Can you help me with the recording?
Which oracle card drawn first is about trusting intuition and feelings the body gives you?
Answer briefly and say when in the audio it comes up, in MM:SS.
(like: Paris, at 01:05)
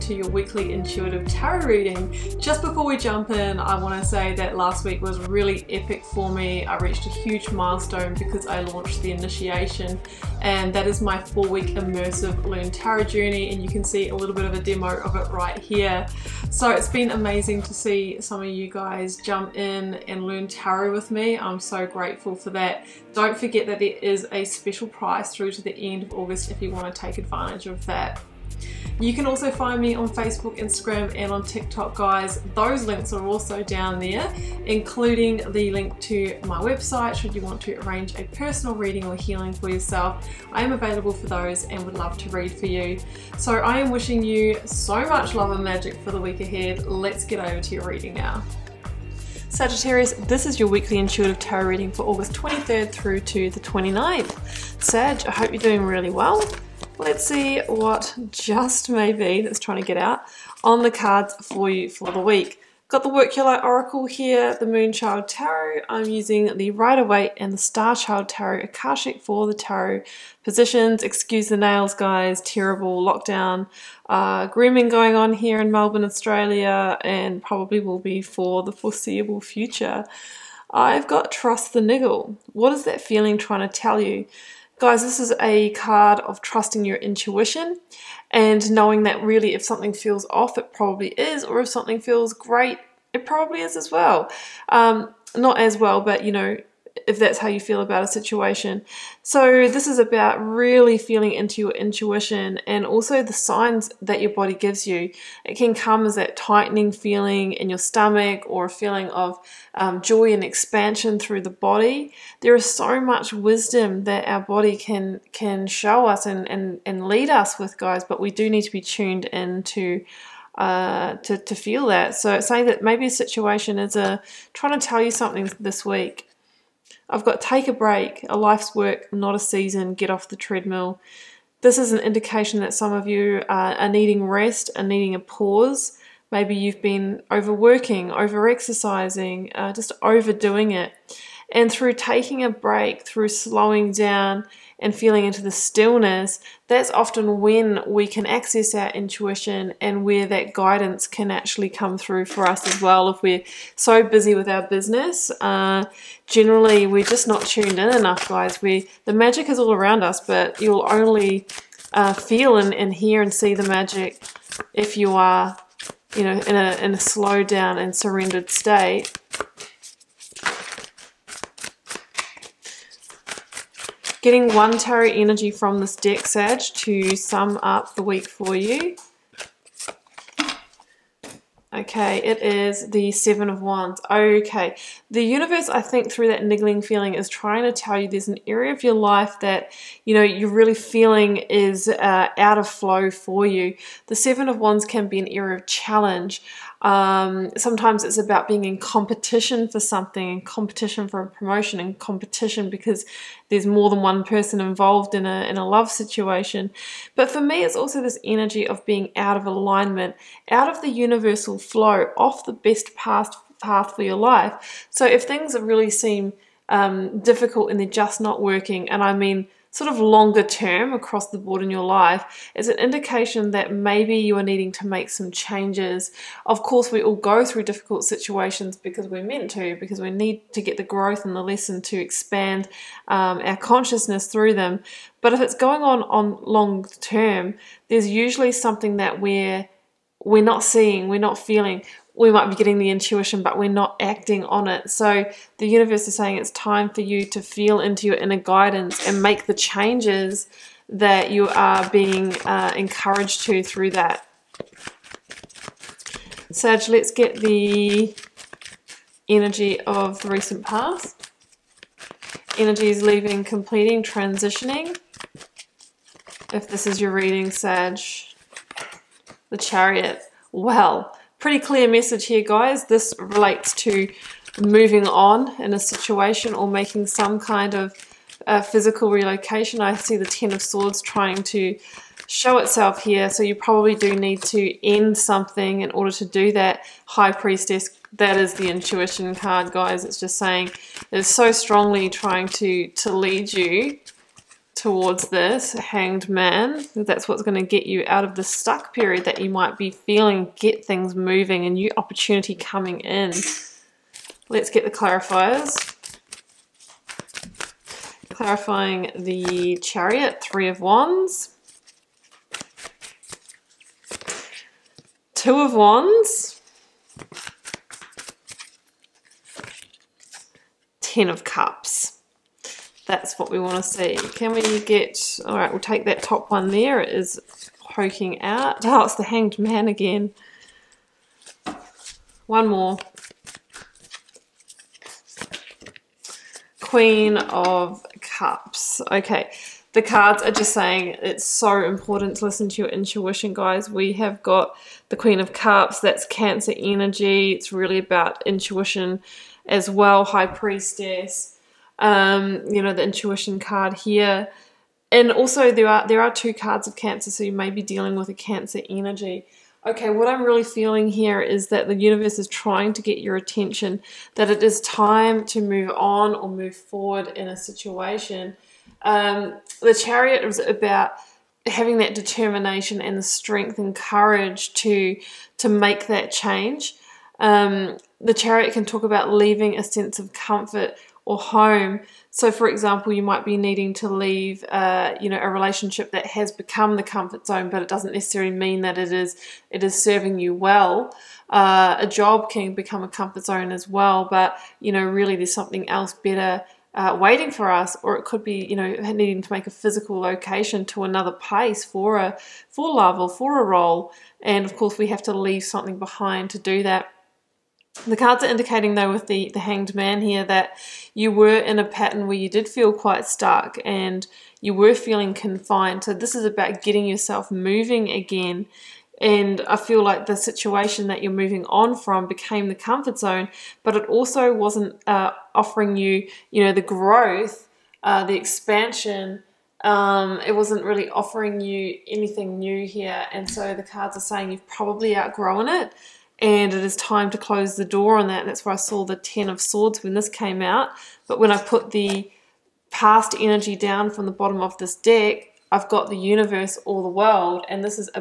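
Trust the Niggle, at 01:21.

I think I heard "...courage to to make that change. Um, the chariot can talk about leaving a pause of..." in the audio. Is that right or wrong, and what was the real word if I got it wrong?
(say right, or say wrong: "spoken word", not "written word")
wrong: "sense", not "pause".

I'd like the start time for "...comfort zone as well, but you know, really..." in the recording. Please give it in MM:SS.
06:33.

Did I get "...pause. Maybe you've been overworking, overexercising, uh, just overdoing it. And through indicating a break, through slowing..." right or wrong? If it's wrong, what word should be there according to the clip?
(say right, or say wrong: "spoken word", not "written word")
wrong: "taking", not "indicating".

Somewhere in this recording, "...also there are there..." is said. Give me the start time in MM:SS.
05:55.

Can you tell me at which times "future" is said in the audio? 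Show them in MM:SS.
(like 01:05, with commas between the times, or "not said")
01:19.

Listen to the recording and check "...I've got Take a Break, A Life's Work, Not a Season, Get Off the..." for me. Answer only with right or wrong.
right.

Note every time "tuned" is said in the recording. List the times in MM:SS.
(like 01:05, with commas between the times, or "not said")
01:58, 02:37.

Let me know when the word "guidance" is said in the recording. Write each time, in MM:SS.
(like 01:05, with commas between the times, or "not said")
02:30, 04:08.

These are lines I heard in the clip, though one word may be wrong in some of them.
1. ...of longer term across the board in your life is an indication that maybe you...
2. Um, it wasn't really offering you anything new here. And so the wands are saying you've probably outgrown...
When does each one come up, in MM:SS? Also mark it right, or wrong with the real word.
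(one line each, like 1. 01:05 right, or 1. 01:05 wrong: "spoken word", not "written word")
1. 03:39 right
2. 07:09 wrong: "cards", not "wands".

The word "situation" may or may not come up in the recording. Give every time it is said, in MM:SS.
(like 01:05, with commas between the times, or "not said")
01:38, 02:03, 03:25, 03:48, 04:35, 06:07, 07:00.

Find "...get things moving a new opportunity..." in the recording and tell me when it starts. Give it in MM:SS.
05:00.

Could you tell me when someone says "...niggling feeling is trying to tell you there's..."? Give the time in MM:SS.
03:06.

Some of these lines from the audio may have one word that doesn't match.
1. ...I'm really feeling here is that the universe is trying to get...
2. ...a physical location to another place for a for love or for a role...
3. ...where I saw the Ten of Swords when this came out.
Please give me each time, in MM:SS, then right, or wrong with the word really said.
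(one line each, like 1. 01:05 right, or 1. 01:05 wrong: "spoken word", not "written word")
1. 06:00 right
2. 06:39 right
3. 07:18 right.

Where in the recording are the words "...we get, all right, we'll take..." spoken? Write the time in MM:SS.
05:24.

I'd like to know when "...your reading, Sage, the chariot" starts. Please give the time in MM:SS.
04:27.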